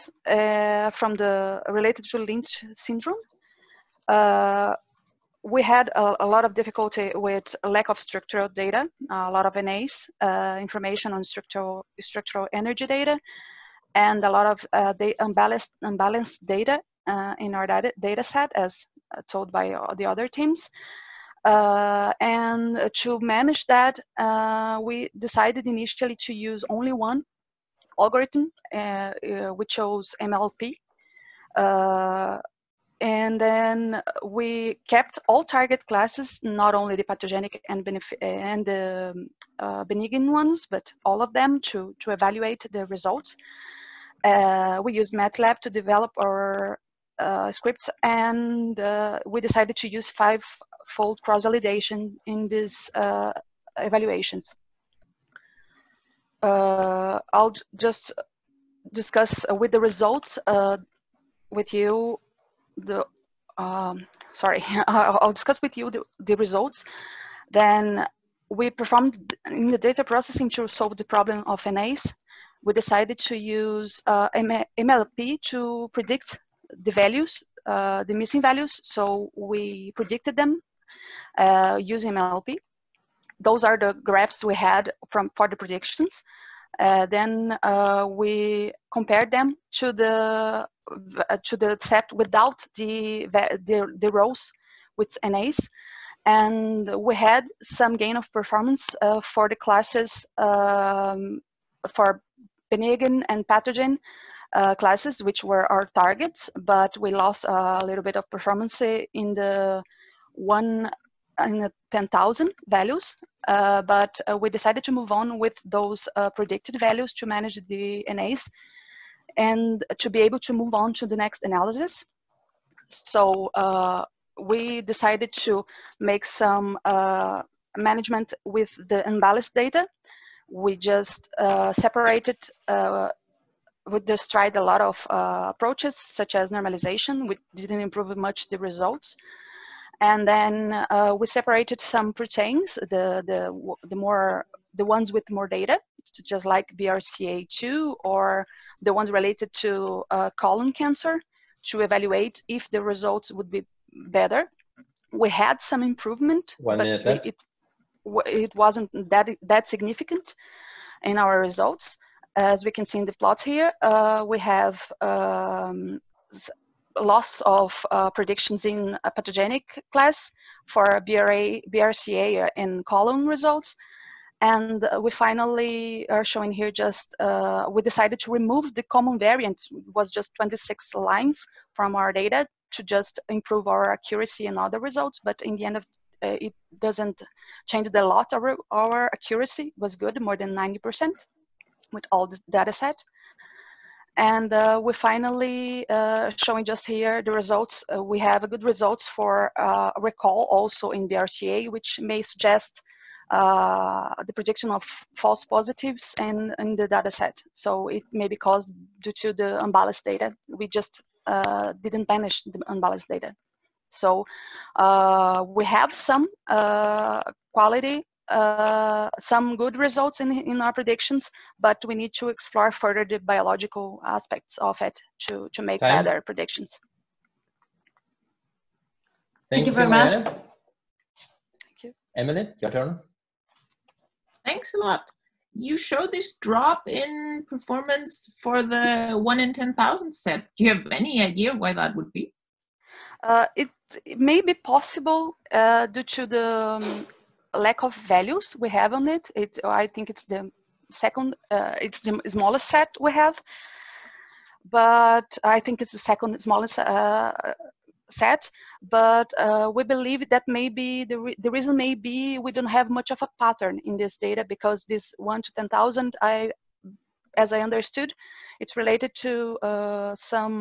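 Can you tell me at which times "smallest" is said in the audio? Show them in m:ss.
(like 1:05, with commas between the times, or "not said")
4:12, 4:16.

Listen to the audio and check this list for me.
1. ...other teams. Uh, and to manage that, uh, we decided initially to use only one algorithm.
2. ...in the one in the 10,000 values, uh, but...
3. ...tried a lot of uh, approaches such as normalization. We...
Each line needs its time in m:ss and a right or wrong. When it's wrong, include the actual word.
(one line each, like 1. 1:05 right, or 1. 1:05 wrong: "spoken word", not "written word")
1. 0:20 right
2. 1:48 right
3. 2:14 right.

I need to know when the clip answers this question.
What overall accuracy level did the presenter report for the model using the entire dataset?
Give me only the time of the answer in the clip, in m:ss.
3:10.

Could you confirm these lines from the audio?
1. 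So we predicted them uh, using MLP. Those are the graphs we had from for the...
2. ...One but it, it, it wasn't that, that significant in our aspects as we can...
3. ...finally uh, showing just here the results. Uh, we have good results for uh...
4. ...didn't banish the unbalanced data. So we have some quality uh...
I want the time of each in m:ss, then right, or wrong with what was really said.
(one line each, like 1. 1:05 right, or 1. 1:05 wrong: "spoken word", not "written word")
1. 1:18 right
2. 2:36 wrong: "results", not "aspects"
3. 3:14 right
4. 3:31 right.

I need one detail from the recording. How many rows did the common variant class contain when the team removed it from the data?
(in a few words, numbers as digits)
26.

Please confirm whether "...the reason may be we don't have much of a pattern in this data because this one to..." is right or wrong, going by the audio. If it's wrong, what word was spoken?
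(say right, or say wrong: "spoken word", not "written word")
right.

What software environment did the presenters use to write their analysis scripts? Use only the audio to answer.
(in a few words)
MATLAB.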